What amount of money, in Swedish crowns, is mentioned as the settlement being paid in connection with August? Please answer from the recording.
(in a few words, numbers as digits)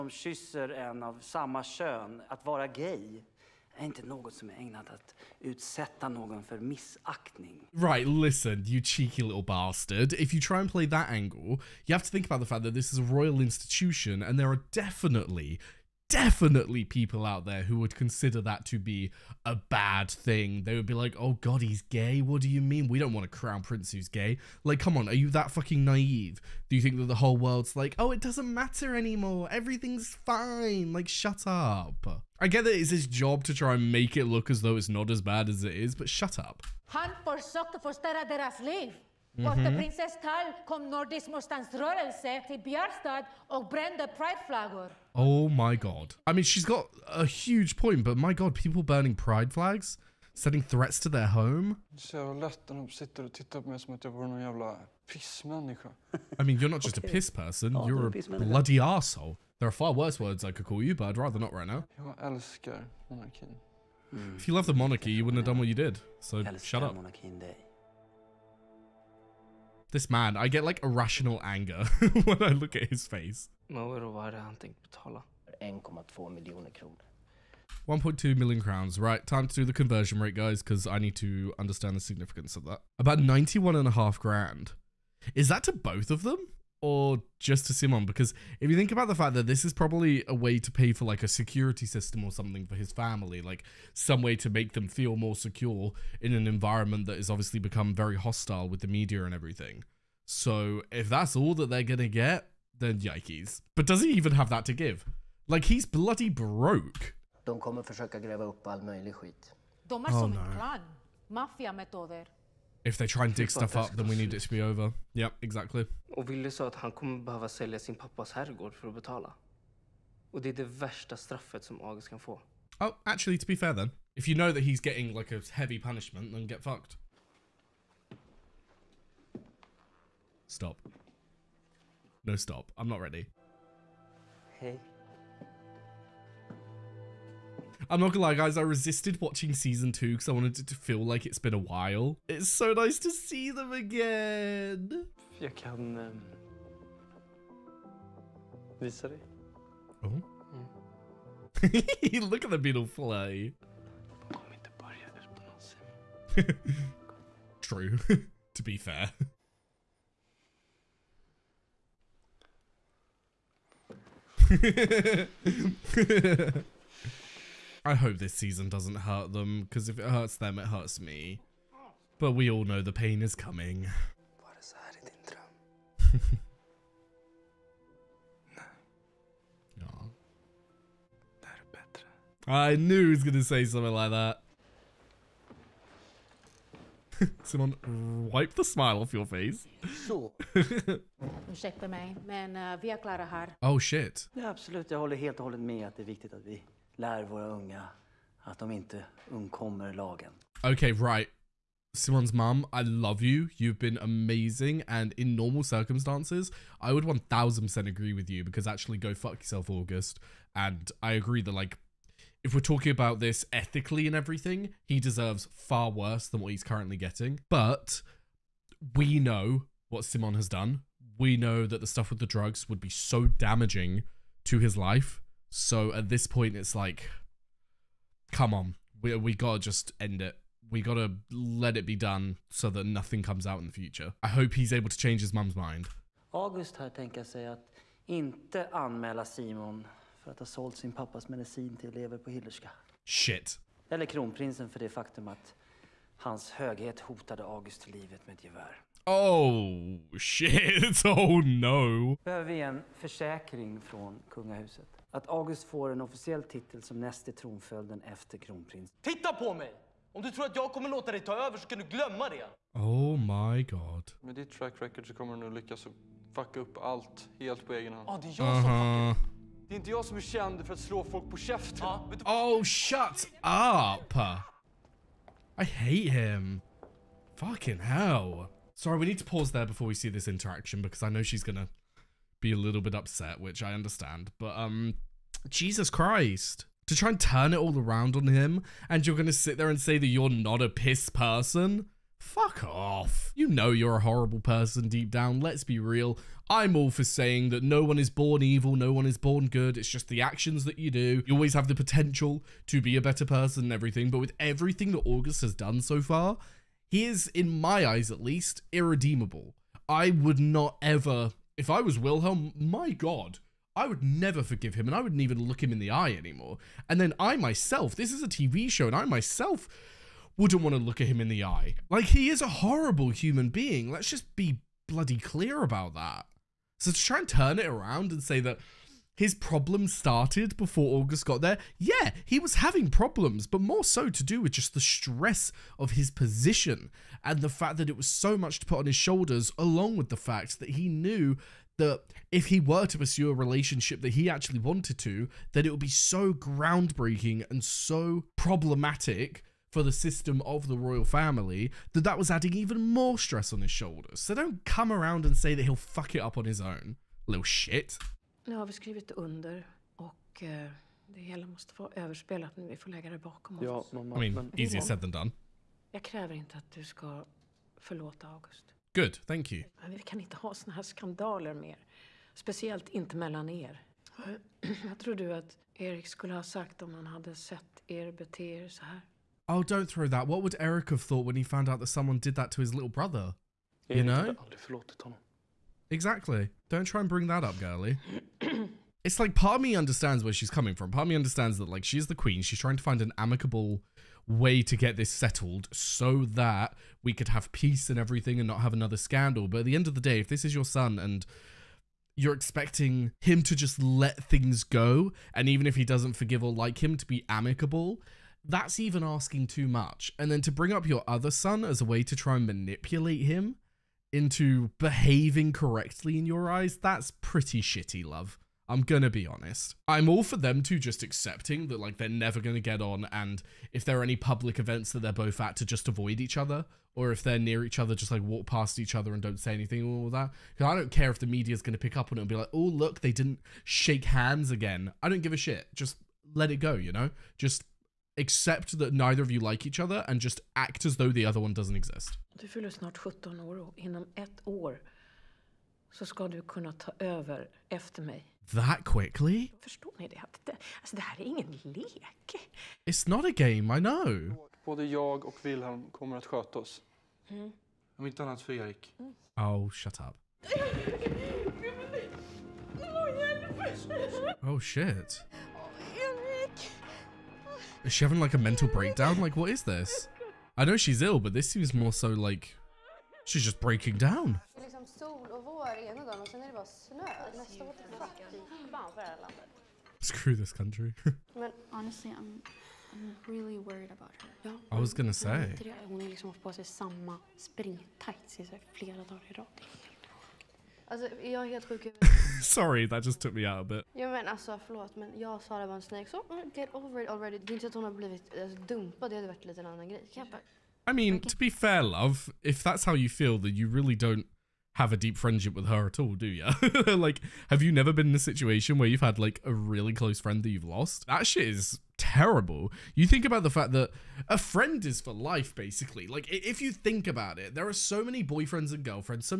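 1.2 million crowns.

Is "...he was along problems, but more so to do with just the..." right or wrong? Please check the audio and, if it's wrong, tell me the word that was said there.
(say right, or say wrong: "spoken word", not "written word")
wrong: "having", not "along".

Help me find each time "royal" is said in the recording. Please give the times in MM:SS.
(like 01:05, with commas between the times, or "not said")
00:13, 05:50.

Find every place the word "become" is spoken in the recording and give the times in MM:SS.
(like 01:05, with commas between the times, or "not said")
01:37.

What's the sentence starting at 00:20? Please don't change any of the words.
They would be like, oh god, he's gay?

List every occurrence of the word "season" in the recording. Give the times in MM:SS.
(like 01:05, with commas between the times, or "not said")
02:19, 02:48.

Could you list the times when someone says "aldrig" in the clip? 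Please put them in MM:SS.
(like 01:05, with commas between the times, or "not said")
06:24.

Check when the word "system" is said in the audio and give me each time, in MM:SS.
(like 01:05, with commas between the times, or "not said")
01:31, 05:49.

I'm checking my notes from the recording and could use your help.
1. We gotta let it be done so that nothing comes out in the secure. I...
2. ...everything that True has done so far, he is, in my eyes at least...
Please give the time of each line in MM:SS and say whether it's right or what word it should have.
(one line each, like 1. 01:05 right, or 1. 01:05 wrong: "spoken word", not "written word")
1. 03:50 wrong: "future", not "secure"
2. 05:04 wrong: "August", not "True".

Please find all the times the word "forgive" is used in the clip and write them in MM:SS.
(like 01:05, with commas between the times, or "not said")
05:14, 06:46.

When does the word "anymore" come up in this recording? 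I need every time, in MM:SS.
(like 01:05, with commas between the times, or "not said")
00:28, 05:16.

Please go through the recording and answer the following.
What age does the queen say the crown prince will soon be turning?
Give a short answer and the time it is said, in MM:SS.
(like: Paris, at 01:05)
17, at 07:22.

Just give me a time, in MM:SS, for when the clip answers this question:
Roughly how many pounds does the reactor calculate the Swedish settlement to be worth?
01:22.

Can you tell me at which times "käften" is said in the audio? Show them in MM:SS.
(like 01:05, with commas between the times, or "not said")
04:31.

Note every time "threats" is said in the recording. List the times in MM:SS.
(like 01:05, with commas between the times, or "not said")
00:50.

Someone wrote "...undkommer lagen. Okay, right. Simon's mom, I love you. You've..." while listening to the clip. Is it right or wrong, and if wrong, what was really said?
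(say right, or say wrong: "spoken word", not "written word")
right.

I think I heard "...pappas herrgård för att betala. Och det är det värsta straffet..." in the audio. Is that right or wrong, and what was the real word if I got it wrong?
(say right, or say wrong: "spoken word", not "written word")
right.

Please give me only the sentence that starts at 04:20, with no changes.
Om du tror att jag kommer låta dig ta över så kan du glömma det.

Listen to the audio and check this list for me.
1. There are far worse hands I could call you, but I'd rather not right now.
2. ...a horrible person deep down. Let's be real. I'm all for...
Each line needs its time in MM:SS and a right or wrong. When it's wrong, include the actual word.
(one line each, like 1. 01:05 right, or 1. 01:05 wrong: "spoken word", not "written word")
1. 00:59 wrong: "words", not "hands"
2. 04:53 right.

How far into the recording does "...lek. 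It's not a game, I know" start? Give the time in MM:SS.
07:31.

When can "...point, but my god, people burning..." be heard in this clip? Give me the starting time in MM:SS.
00:47.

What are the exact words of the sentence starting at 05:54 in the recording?
So don't come around and say that he'll fuck it up on his own, little shit.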